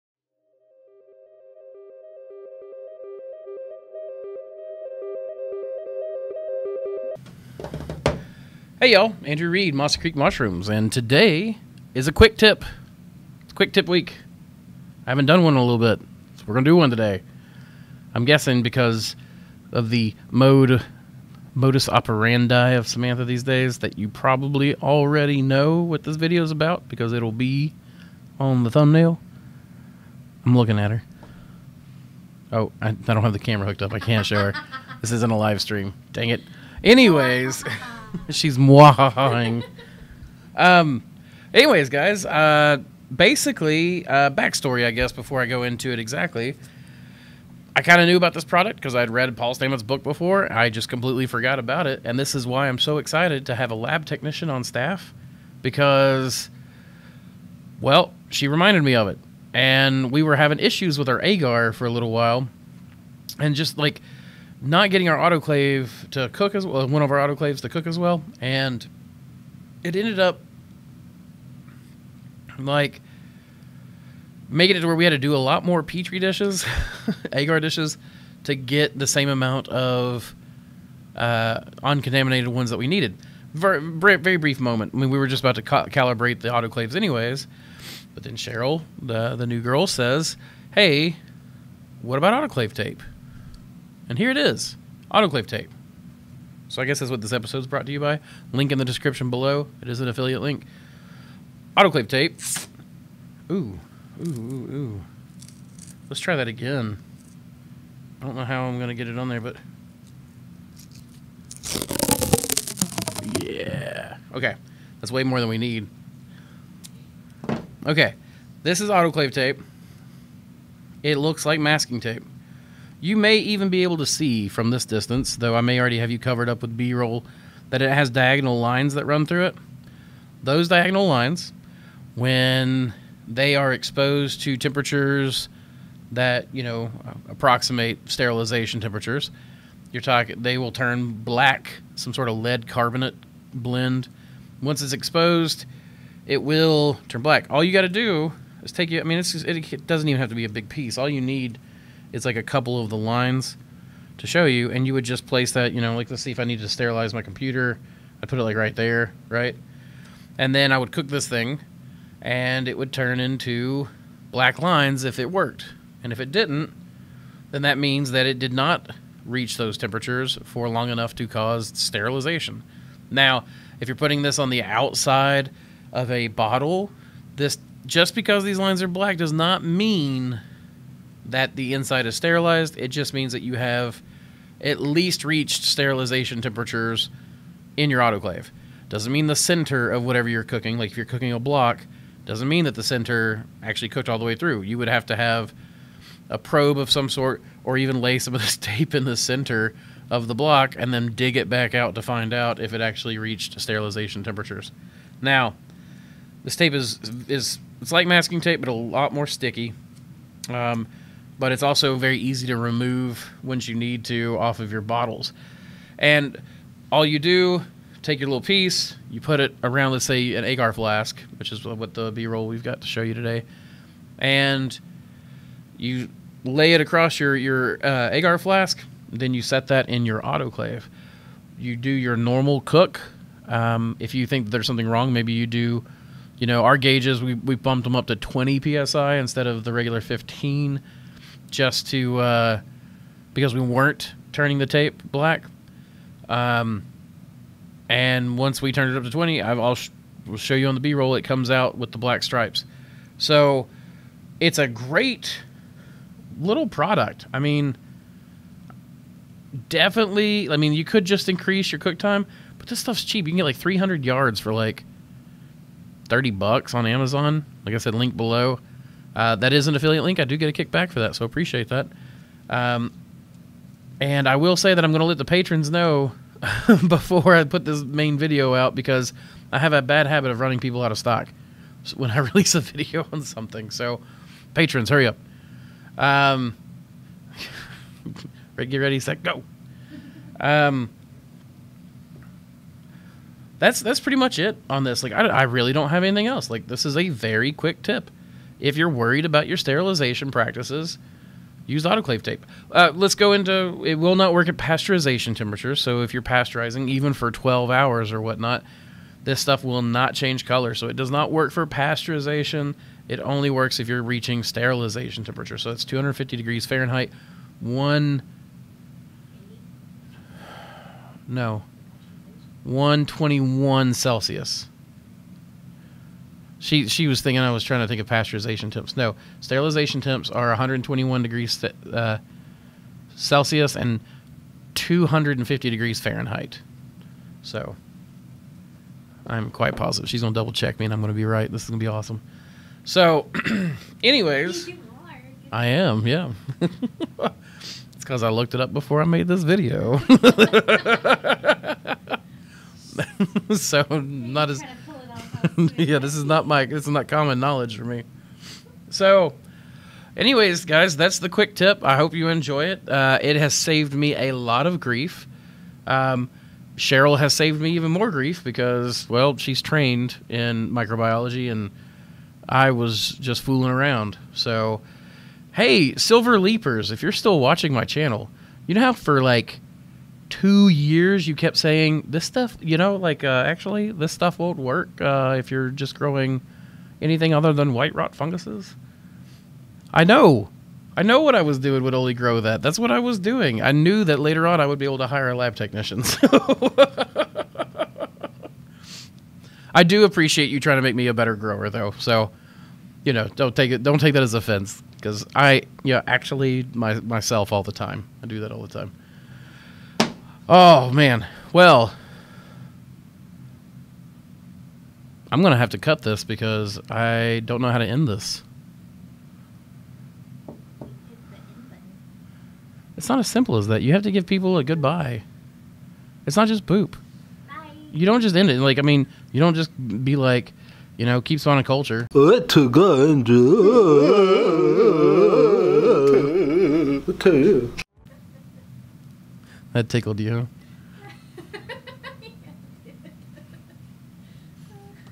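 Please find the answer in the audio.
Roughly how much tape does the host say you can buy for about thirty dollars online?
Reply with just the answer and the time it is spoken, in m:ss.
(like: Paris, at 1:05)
300 yards, at 4:23.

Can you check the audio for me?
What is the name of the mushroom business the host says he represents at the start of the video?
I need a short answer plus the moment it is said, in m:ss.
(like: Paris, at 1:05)
Mossy Creek Mushrooms, at 0:09.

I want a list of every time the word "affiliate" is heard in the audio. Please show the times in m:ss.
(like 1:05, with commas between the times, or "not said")
1:40, 4:29.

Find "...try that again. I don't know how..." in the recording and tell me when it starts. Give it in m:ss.
1:46.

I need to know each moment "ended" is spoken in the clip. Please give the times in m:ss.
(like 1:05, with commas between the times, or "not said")
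1:09.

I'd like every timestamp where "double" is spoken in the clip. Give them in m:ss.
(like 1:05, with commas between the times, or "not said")
5:40.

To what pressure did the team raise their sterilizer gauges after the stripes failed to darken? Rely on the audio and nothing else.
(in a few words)
20 psi.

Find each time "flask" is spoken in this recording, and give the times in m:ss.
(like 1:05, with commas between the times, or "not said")
3:40, 3:48.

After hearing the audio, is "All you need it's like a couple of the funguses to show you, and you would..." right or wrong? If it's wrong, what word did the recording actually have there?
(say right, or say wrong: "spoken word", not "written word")
wrong: "lines", not "funguses".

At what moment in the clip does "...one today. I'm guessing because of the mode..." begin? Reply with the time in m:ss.
0:16.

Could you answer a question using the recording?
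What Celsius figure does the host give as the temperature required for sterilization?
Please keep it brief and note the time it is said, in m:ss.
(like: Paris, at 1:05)
121 degrees Celsius, at 5:22.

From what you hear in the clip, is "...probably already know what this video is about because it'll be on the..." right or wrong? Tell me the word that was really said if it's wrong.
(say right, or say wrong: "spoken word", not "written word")
right.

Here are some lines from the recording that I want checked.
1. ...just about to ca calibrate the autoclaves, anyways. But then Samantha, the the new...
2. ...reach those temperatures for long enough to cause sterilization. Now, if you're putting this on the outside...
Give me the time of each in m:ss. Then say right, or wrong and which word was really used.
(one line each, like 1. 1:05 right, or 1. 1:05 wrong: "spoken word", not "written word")
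1. 1:25 wrong: "Cheryl", not "Samantha"
2. 2:49 right.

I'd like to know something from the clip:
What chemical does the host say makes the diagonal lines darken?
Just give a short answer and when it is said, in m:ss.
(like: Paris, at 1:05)
lead carbonate, at 2:22.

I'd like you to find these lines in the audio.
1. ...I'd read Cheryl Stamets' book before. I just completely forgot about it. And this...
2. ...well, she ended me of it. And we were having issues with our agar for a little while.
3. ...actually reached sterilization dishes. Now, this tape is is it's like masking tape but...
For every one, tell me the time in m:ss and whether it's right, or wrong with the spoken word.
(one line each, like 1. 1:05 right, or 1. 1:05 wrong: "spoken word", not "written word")
1. 0:48 wrong: "Paul", not "Cheryl"
2. 0:57 wrong: "reminded", not "ended"
3. 3:22 wrong: "temperatures", not "dishes".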